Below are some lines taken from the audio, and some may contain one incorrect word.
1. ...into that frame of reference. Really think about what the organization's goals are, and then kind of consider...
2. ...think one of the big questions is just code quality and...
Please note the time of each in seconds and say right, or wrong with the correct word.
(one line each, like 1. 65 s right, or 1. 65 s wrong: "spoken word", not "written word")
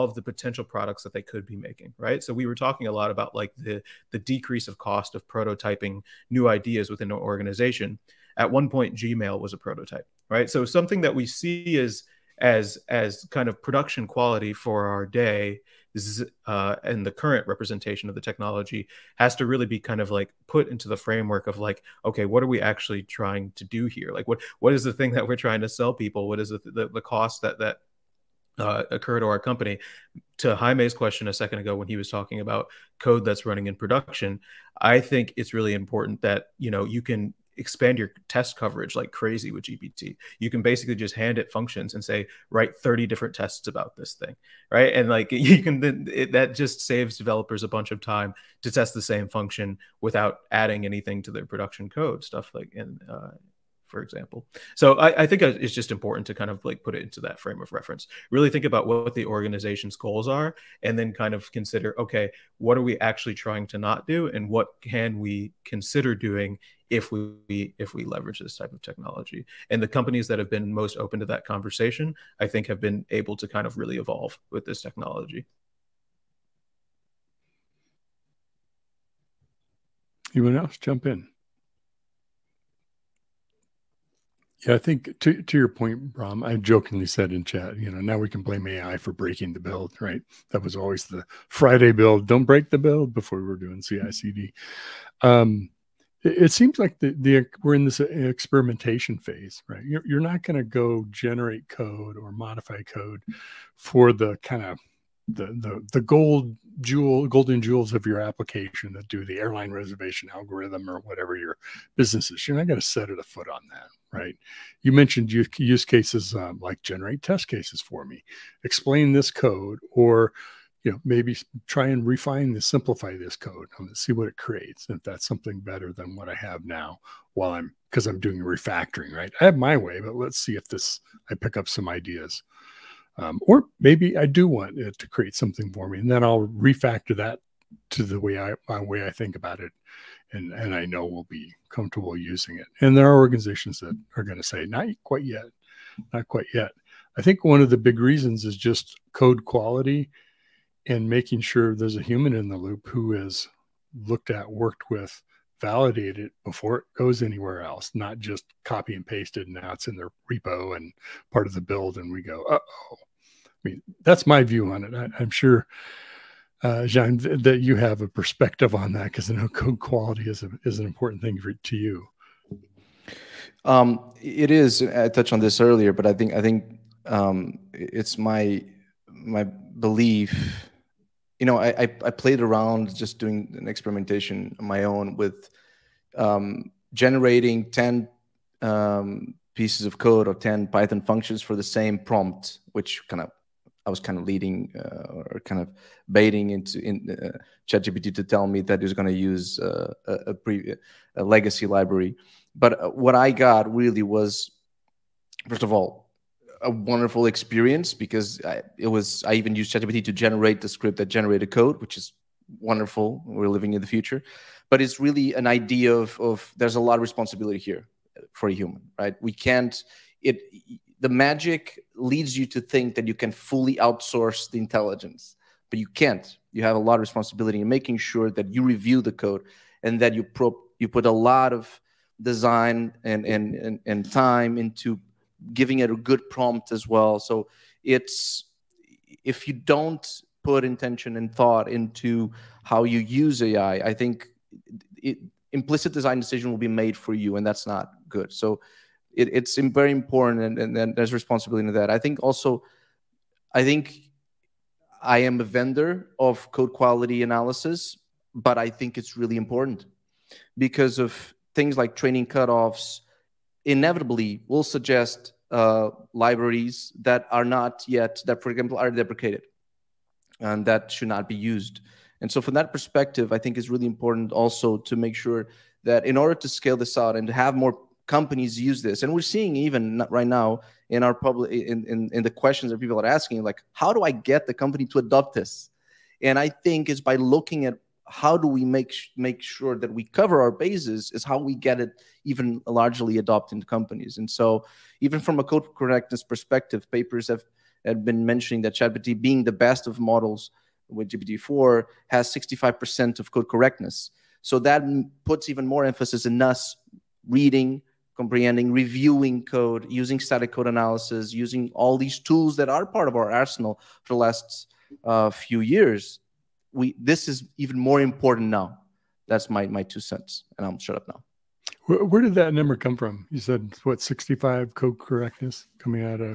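1. 57 s right
2. 147 s wrong: "reasons", not "questions".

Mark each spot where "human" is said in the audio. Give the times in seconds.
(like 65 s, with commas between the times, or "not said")
152 s, 218 s.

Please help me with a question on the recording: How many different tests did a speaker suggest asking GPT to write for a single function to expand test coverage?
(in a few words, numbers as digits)
30.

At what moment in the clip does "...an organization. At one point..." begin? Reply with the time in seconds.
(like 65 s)
7 s.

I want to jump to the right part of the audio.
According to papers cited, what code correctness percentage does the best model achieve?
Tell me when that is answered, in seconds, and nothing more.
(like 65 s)
302 s.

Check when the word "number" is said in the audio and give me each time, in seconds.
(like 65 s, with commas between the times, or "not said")
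322 s.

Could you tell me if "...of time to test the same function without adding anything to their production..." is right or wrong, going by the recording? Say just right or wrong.
right.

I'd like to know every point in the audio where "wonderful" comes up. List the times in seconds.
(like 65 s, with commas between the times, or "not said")
206 s, 212 s.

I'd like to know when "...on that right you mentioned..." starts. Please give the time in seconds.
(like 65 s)
113 s.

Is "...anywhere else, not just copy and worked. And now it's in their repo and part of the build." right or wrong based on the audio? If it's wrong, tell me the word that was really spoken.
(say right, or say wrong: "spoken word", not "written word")
wrong: "pasted", not "worked".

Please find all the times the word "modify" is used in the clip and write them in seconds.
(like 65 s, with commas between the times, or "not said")
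102 s.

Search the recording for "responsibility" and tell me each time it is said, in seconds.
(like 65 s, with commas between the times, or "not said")
217 s, 227 s, 251 s.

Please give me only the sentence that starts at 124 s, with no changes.
And if that's something better than what I have now while I'm, because I'm doing refactoring, right?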